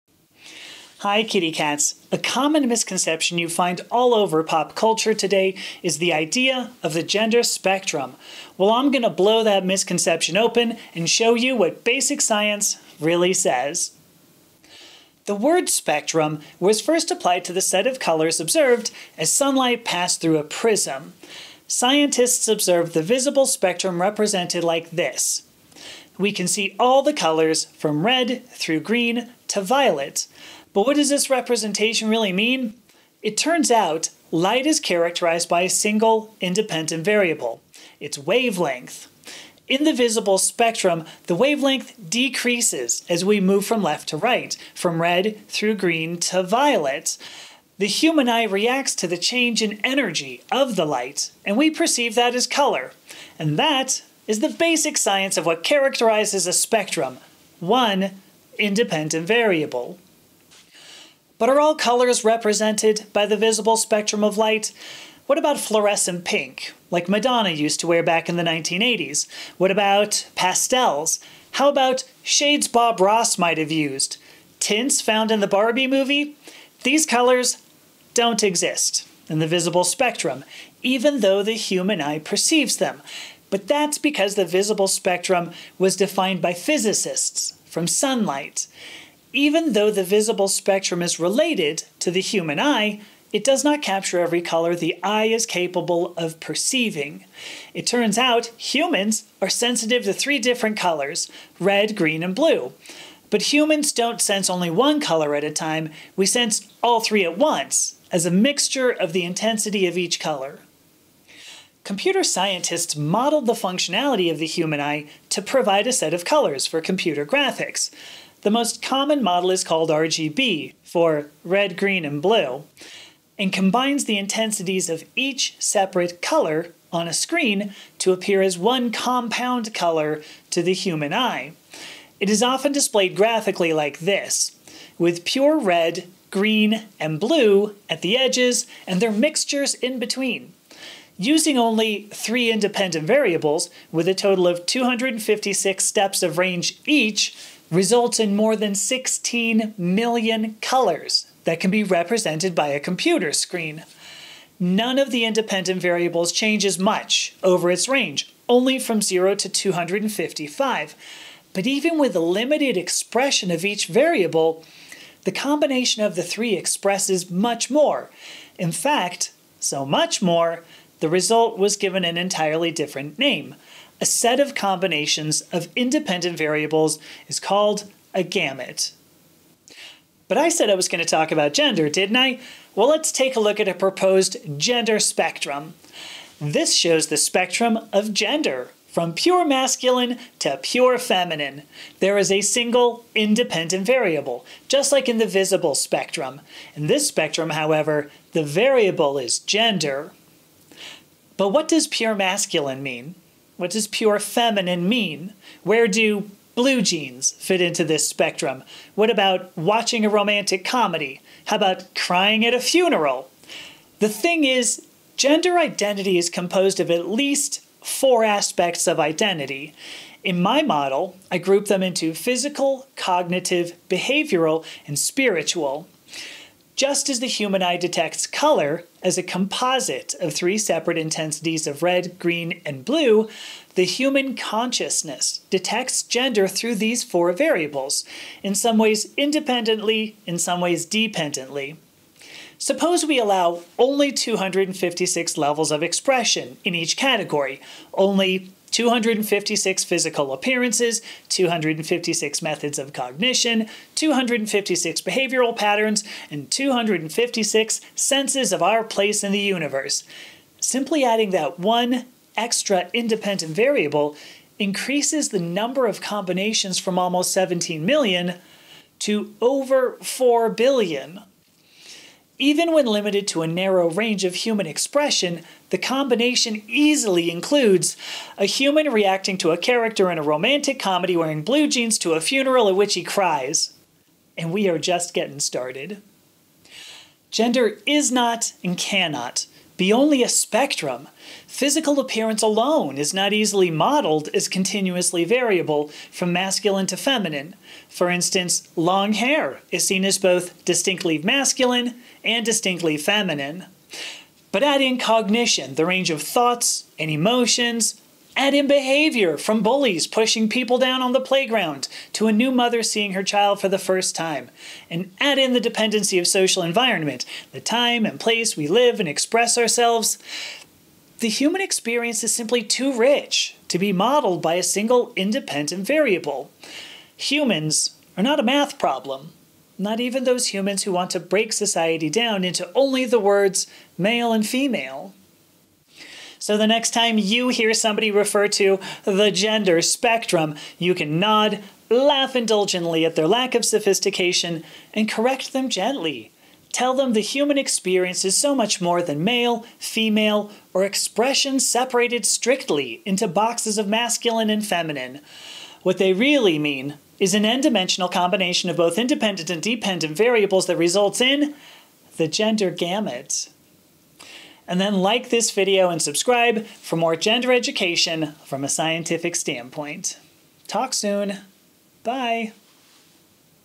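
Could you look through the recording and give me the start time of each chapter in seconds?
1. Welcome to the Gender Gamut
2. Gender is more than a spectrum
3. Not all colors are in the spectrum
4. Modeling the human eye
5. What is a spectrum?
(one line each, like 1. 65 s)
1. 335 s
2. 286 s
3. 60 s
4. 111 s
5. 14 s.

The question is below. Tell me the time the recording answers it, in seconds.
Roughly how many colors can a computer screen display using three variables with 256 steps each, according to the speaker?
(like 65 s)
148 s.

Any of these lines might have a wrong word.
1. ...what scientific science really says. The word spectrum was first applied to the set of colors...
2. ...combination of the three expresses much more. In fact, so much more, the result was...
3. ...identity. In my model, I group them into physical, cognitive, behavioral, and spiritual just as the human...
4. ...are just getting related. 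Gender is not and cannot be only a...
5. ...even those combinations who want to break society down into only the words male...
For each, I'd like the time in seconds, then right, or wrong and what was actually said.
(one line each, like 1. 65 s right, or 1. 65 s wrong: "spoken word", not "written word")
1. 11 s wrong: "basic", not "scientific"
2. 165 s right
3. 218 s right
4. 284 s wrong: "started", not "related"
5. 329 s wrong: "humans", not "combinations".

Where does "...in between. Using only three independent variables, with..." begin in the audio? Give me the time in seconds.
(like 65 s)
139 s.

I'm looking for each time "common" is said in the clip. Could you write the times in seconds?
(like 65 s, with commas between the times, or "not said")
2 s, 118 s.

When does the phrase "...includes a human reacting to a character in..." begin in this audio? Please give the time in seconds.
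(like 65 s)
277 s.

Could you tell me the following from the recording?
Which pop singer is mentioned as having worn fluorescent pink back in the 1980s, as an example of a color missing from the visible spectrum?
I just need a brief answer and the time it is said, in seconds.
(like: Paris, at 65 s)
Madonna, at 67 s.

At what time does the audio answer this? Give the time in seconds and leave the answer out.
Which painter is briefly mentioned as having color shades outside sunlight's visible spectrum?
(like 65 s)
72 s.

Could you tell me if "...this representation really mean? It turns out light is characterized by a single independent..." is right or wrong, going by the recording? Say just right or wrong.
right.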